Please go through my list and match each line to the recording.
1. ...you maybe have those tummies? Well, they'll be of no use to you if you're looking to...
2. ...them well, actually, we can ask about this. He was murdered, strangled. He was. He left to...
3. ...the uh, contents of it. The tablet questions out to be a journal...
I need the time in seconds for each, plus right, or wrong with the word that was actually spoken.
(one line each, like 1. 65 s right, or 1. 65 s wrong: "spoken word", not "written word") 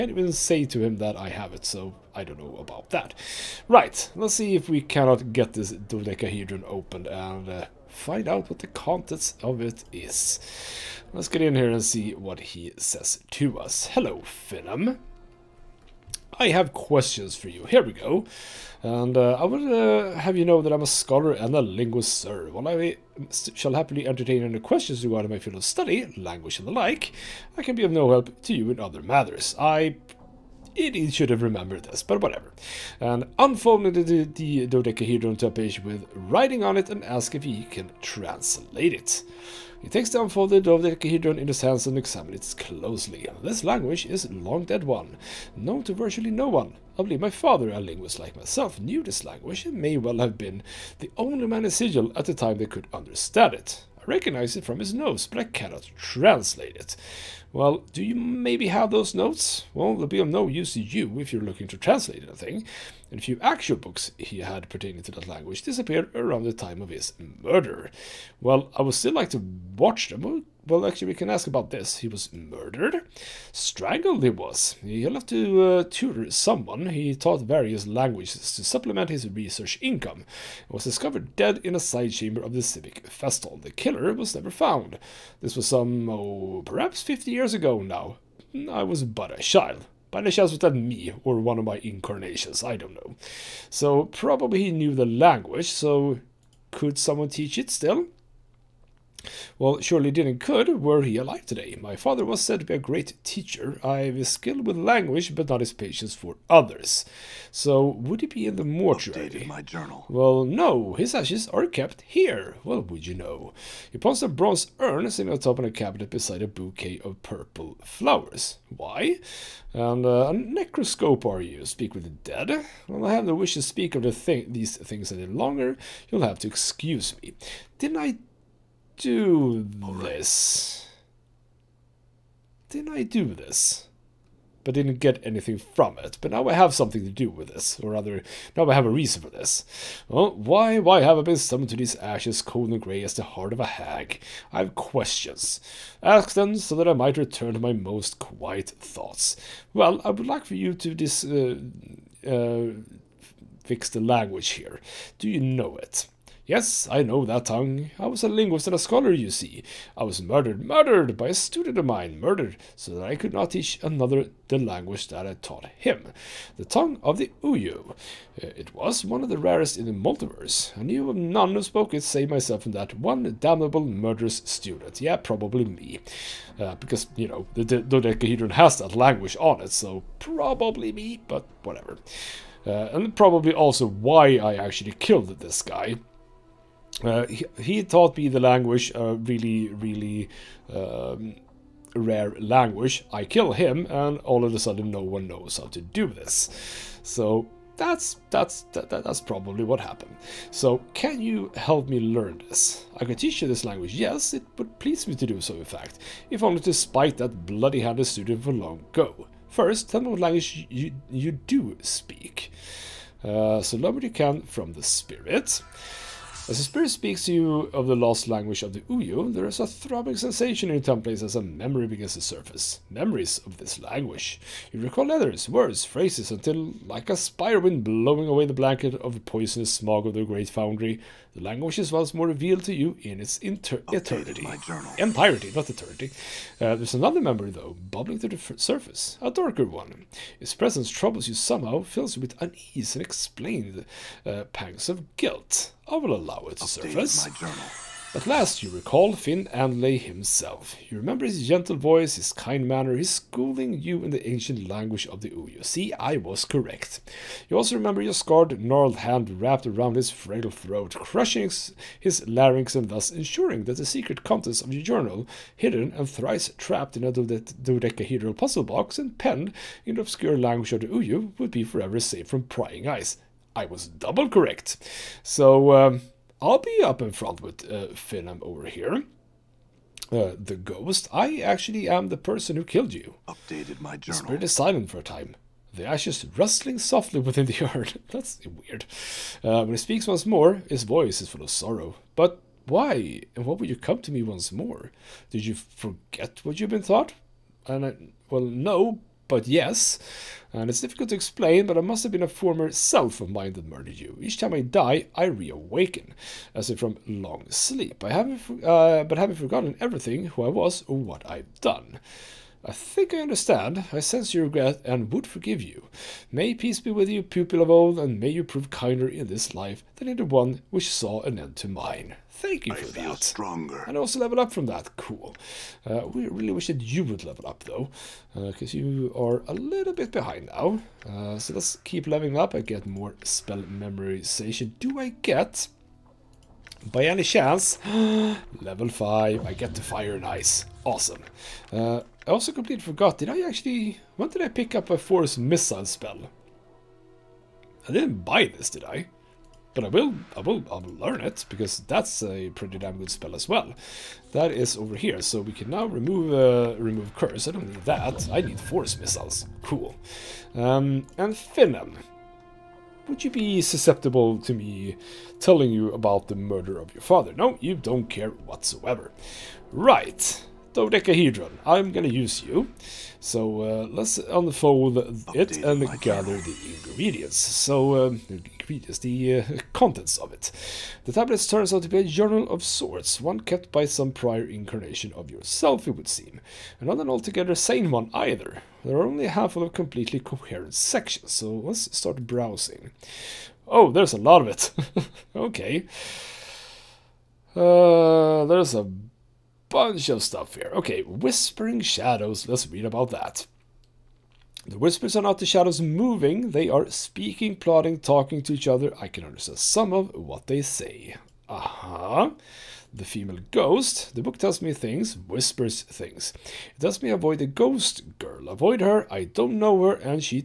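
1. 58 s wrong: "notes", not "tummies"
2. 70 s right
3. 378 s wrong: "turns", not "questions".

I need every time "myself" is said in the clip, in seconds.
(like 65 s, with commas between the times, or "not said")
48 s, 172 s.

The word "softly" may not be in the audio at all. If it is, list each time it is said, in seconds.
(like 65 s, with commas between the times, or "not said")
286 s.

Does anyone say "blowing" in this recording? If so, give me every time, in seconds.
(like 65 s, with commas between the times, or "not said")
227 s.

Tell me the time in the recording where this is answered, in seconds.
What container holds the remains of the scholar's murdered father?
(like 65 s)
114 s.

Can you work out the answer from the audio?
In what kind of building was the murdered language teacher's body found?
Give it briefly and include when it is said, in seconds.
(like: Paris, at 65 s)
civic Festhall, at 82 s.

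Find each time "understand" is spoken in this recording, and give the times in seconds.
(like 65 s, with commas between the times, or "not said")
52 s, 313 s, 409 s.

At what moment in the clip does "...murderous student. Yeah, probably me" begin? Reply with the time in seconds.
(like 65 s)
173 s.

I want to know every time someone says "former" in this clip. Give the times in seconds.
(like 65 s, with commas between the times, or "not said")
302 s.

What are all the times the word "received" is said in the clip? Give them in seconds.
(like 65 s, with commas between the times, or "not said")
not said.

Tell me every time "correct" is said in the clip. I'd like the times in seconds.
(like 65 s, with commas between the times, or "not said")
256 s, 274 s.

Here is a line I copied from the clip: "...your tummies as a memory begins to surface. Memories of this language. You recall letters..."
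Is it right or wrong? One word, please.
right.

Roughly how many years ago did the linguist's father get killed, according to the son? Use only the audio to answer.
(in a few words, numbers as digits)
50 years.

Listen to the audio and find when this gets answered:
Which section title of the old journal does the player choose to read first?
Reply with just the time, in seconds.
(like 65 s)
401 s.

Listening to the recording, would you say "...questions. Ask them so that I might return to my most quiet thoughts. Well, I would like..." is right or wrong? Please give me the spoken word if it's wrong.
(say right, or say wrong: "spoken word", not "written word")
right.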